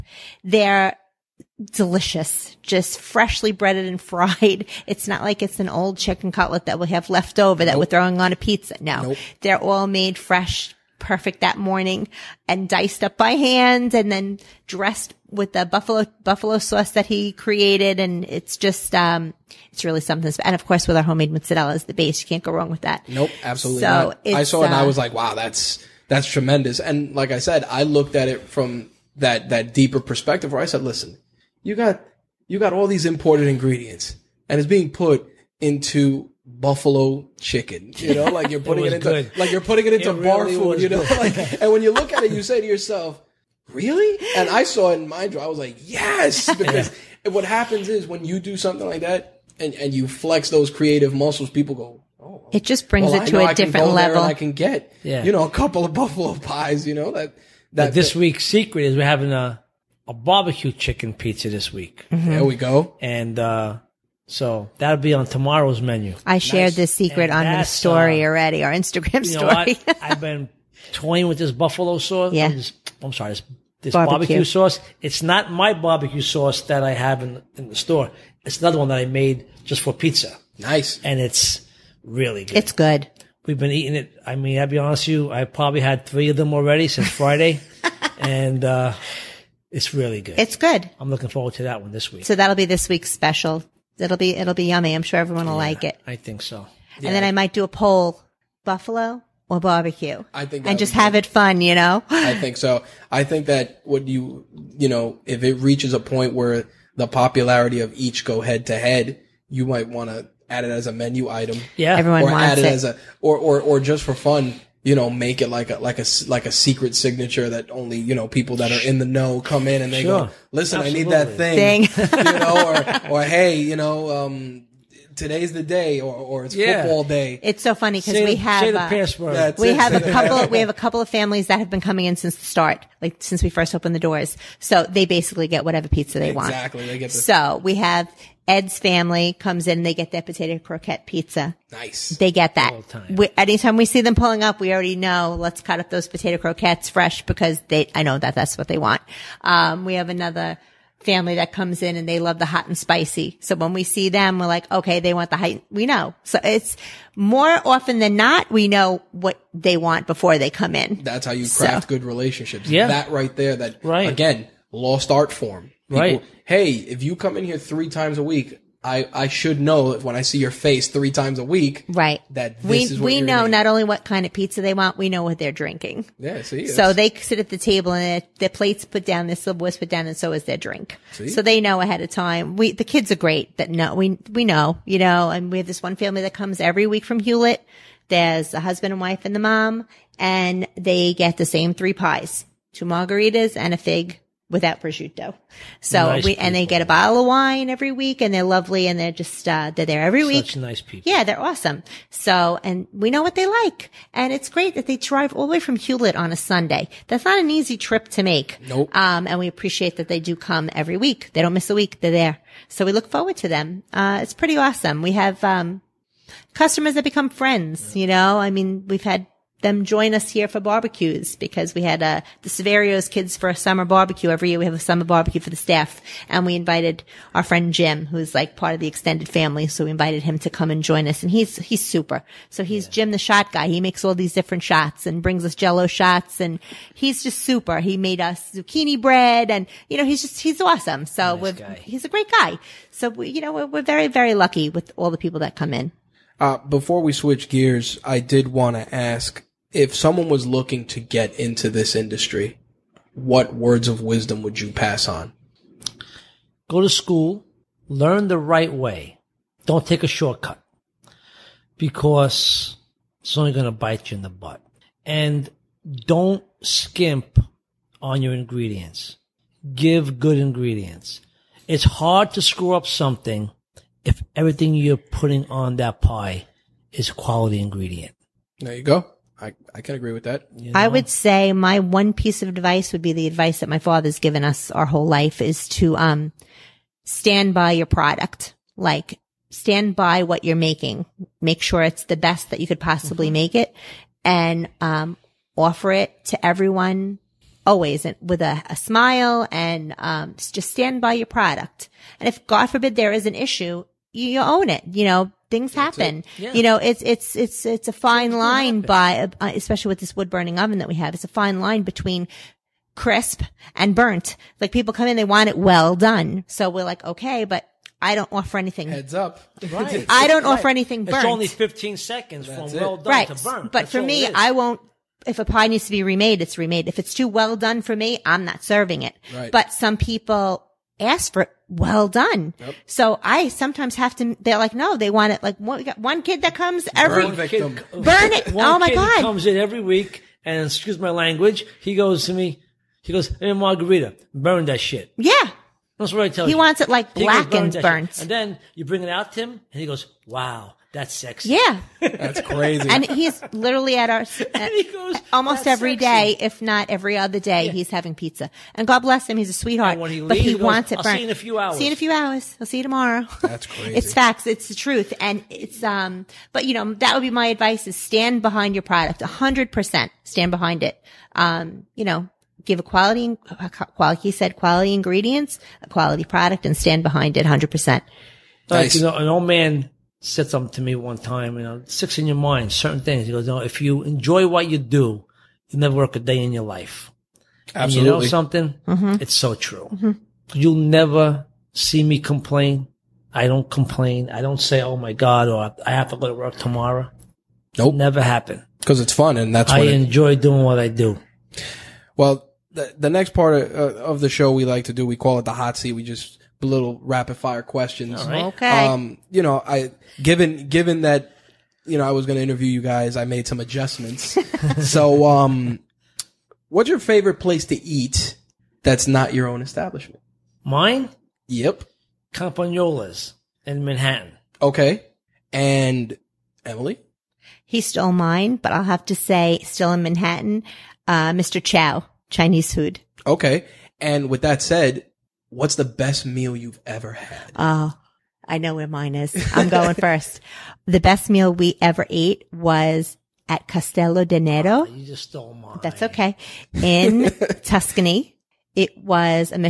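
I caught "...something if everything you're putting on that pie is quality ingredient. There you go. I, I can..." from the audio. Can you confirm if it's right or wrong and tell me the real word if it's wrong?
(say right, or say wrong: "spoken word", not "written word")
right.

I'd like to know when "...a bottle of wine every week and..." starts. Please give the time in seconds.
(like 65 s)
196 s.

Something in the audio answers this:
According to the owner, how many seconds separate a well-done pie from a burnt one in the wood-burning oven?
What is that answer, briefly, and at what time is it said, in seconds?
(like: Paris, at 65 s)
15 seconds, at 321 s.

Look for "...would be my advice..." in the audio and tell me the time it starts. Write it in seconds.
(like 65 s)
367 s.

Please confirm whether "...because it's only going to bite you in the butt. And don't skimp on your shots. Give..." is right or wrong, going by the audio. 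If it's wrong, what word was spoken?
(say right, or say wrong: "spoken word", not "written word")
wrong: "ingredients", not "shots".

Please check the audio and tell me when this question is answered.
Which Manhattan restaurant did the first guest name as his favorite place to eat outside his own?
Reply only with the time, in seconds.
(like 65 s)
422 s.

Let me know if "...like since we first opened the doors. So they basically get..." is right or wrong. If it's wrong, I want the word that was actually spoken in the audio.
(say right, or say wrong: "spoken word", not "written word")
right.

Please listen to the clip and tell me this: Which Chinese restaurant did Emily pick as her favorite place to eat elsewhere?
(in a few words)
Mr. Chow.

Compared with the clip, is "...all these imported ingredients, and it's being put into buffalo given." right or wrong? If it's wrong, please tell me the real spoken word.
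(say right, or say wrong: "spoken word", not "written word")
wrong: "chicken", not "given".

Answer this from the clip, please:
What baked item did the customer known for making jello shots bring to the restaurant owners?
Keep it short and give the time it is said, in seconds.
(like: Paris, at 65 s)
Zucchini bread, at 238 s.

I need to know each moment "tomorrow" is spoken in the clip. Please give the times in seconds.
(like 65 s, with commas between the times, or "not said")
65 s, 362 s, 396 s.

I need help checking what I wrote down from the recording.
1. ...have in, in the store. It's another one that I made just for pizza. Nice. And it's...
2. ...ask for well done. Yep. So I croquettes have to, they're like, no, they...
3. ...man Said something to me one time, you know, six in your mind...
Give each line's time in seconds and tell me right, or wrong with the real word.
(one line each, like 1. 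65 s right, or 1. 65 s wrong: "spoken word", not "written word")
1. 76 s right
2. 330 s wrong: "sometimes", not "croquettes"
3. 379 s right.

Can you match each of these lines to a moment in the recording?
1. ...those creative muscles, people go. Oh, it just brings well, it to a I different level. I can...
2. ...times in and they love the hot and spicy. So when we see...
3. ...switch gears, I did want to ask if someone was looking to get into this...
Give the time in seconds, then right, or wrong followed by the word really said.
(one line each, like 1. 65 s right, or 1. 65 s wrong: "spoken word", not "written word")
1. 50 s right
2. 151 s wrong: "comes", not "times"
3. 247 s right.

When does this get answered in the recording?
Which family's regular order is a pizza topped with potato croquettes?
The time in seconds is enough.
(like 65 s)
138 s.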